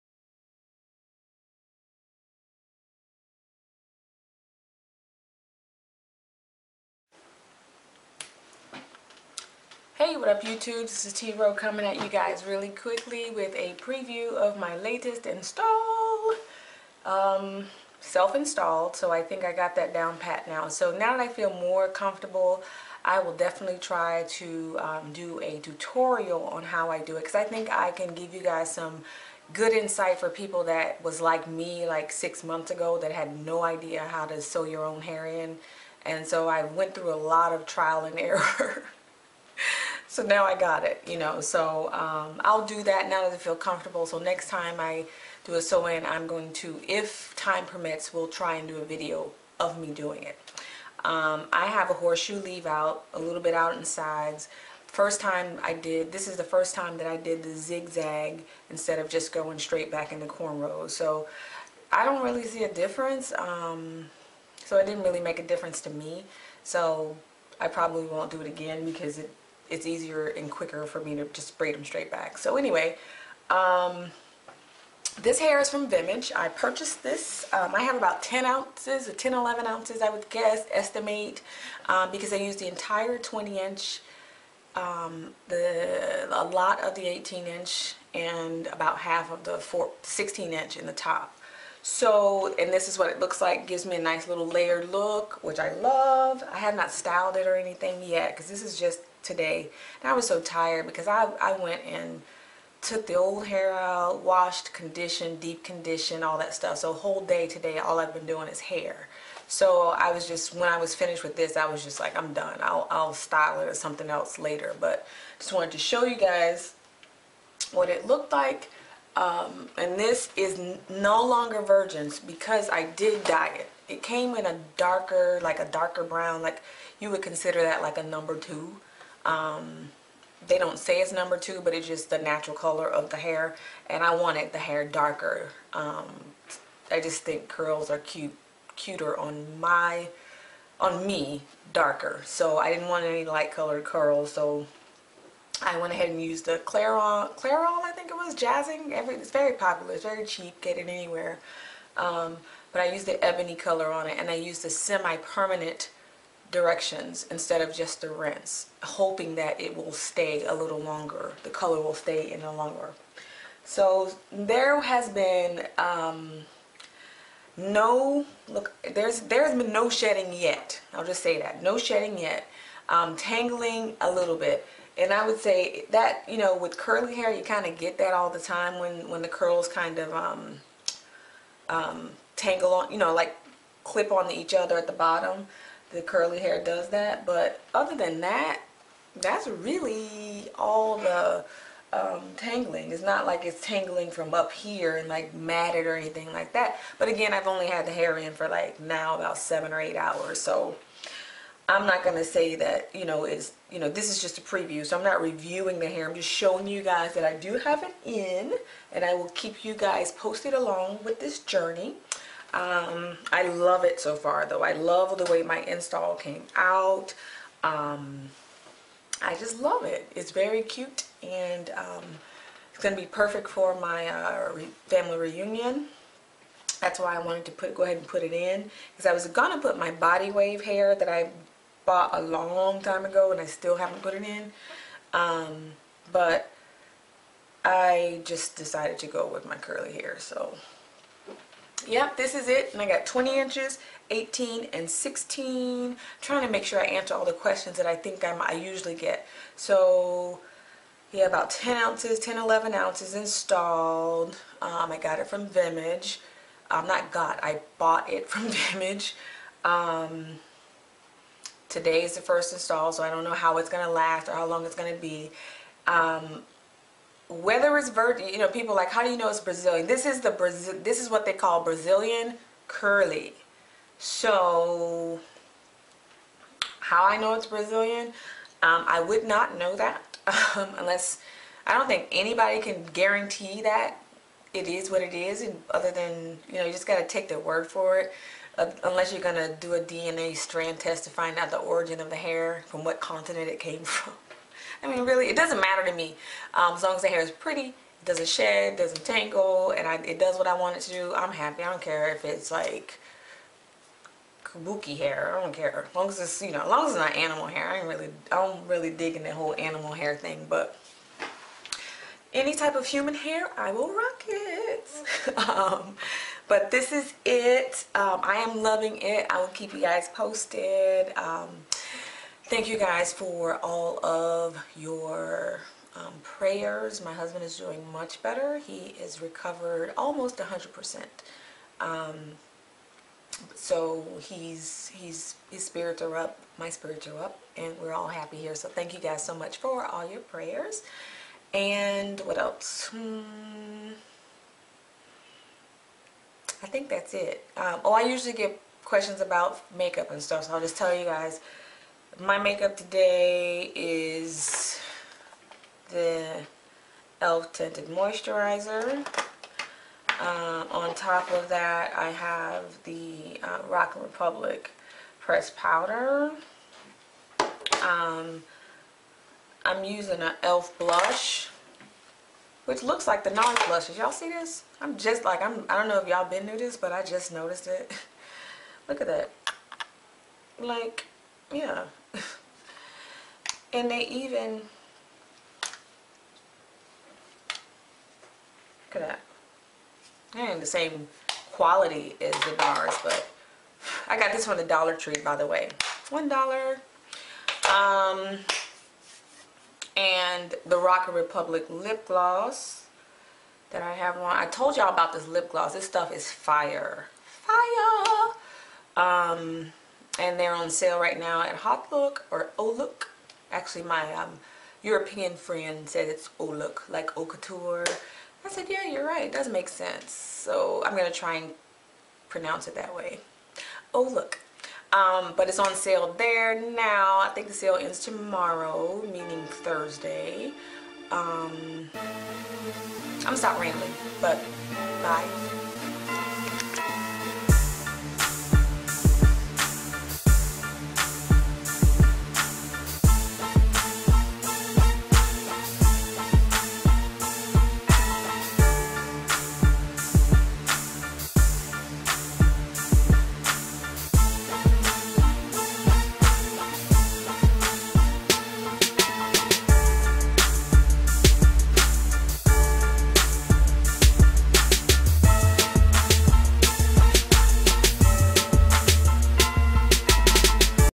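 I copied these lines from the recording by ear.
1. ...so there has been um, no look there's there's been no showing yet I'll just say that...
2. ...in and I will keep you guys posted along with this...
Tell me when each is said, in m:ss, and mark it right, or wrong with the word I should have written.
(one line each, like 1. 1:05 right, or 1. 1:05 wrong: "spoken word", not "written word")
1. 2:43 wrong: "shedding", not "showing"
2. 3:28 right.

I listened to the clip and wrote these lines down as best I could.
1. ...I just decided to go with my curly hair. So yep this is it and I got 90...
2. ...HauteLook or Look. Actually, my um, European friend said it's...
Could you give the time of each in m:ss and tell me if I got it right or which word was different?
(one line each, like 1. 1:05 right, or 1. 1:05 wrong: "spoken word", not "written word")
1. 3:57 wrong: "20", not "90"
2. 6:51 right.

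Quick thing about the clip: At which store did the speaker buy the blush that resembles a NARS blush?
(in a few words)
Dollar Tree.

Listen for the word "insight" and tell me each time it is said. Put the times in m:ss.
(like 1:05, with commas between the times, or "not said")
0:29.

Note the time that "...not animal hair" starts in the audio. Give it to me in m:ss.
5:06.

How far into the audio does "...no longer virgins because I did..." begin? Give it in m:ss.
2:00.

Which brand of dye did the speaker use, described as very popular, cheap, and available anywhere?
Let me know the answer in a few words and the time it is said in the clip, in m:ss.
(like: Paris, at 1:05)
Jazzing, at 2:28.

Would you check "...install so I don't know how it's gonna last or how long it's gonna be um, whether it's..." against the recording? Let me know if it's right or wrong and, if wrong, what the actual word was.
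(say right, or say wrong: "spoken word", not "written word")
right.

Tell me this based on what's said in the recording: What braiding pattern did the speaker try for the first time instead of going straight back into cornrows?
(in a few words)
zigzag.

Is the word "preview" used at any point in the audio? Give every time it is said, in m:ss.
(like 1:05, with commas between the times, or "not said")
0:13, 3:24.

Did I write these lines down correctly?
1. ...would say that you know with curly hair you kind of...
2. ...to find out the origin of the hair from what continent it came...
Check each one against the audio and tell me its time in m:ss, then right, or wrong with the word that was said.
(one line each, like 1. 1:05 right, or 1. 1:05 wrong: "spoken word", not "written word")
1. 2:55 right
2. 4:51 right.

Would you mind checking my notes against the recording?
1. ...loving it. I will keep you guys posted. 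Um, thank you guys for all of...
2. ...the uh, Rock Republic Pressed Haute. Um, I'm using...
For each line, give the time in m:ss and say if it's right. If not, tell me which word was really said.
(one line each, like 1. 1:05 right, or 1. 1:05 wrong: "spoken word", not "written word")
1. 5:18 right
2. 6:02 wrong: "Powder", not "Haute".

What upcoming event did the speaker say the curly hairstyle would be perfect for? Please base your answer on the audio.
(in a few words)
family reunion.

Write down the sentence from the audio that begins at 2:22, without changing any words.
So I didn't want any light colored curls.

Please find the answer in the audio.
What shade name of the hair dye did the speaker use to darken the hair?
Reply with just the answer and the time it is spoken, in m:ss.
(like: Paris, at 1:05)
ebony, at 2:33.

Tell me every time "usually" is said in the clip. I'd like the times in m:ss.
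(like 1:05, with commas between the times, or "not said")
4:08, 5:48.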